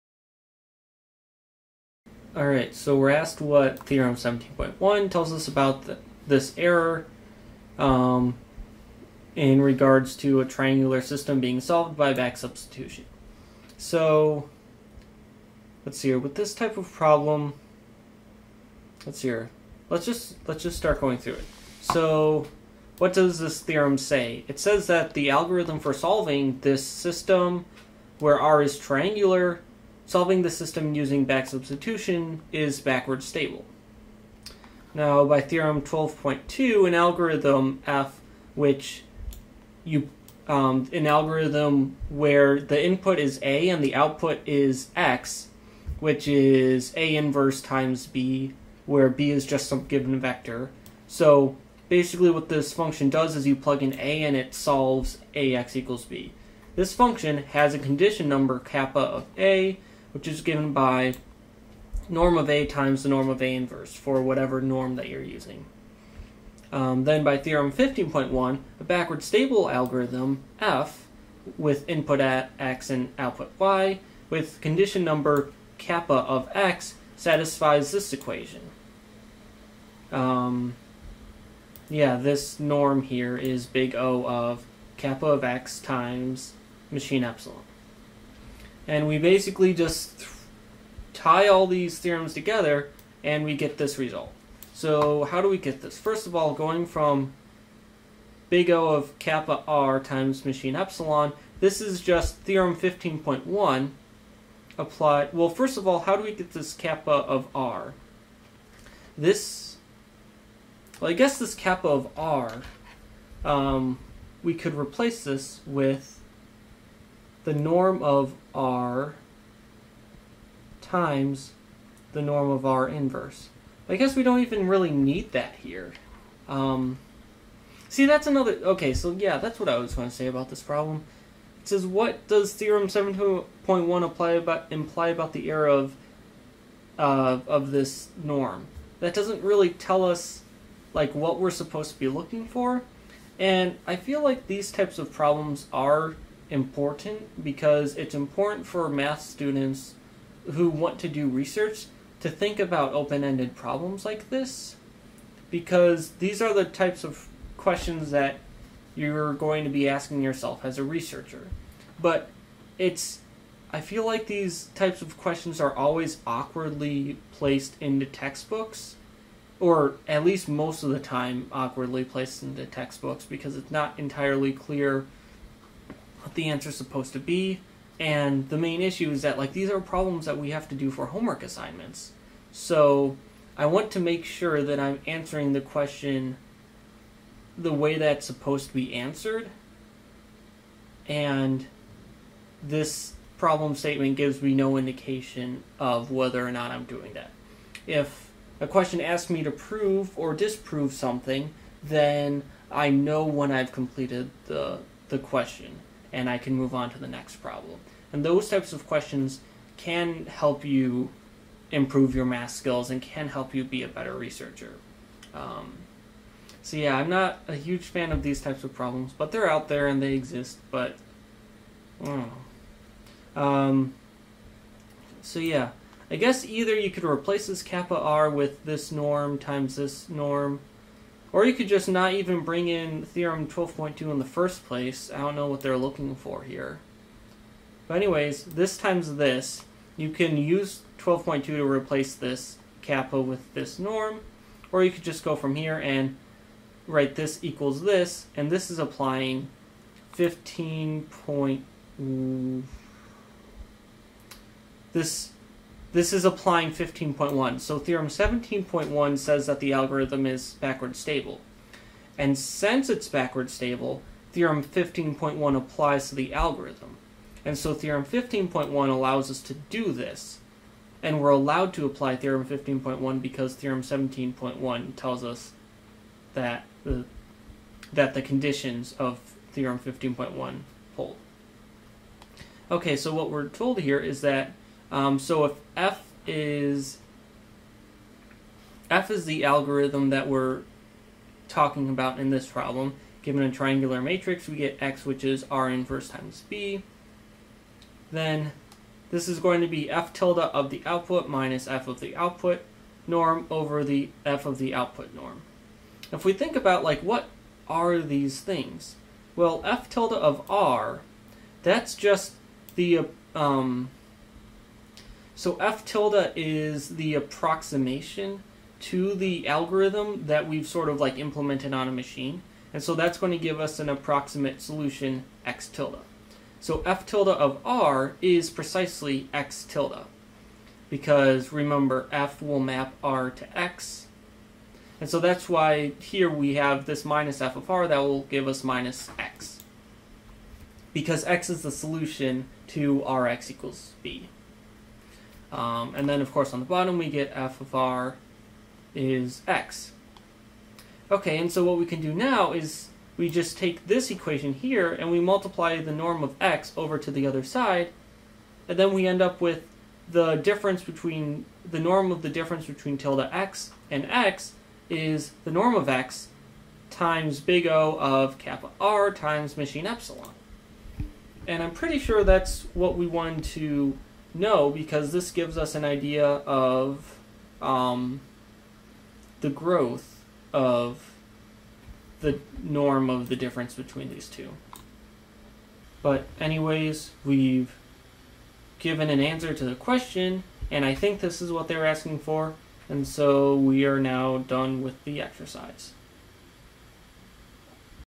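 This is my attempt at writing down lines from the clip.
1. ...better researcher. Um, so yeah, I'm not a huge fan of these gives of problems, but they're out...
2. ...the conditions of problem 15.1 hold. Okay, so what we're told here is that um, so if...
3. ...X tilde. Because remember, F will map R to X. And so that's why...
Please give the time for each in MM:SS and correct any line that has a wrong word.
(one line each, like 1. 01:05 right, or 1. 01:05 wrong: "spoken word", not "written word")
1. 03:33 wrong: "types", not "gives"
2. 04:38 wrong: "theorem", not "problem"
3. 05:29 right.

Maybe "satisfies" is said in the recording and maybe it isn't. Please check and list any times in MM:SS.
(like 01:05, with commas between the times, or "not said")
01:17.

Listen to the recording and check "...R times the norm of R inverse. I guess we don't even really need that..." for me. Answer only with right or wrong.
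right.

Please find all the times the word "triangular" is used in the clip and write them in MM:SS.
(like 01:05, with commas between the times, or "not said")
00:10, 00:28, 04:53.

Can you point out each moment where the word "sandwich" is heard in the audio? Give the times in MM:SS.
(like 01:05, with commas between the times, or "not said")
not said.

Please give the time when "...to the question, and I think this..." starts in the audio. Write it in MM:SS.
06:29.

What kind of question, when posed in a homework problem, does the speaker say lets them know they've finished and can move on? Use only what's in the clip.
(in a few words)
prove or disprove.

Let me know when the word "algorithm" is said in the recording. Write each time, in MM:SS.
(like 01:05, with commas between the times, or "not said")
00:25, 00:36, 00:41, 01:09, 04:19, 04:26, 04:49, 05:19.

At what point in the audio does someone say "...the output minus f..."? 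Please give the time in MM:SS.
05:00.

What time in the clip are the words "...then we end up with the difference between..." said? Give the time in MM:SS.
05:58.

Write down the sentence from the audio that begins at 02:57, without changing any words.
And the main issue is that like these are problems that we have to do for homework assignments.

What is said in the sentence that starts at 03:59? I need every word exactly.
You can use 12.2 to replace this kappa with this norm.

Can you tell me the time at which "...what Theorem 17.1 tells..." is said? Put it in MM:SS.
00:03.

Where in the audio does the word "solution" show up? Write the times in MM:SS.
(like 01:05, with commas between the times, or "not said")
05:24, 05:41.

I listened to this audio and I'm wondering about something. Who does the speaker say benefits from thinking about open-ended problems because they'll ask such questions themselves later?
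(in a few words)
math students who want to do research.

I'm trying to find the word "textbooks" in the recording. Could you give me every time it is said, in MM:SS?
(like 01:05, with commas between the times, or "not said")
02:48, 02:52.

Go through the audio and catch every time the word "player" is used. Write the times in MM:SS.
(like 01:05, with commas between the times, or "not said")
not said.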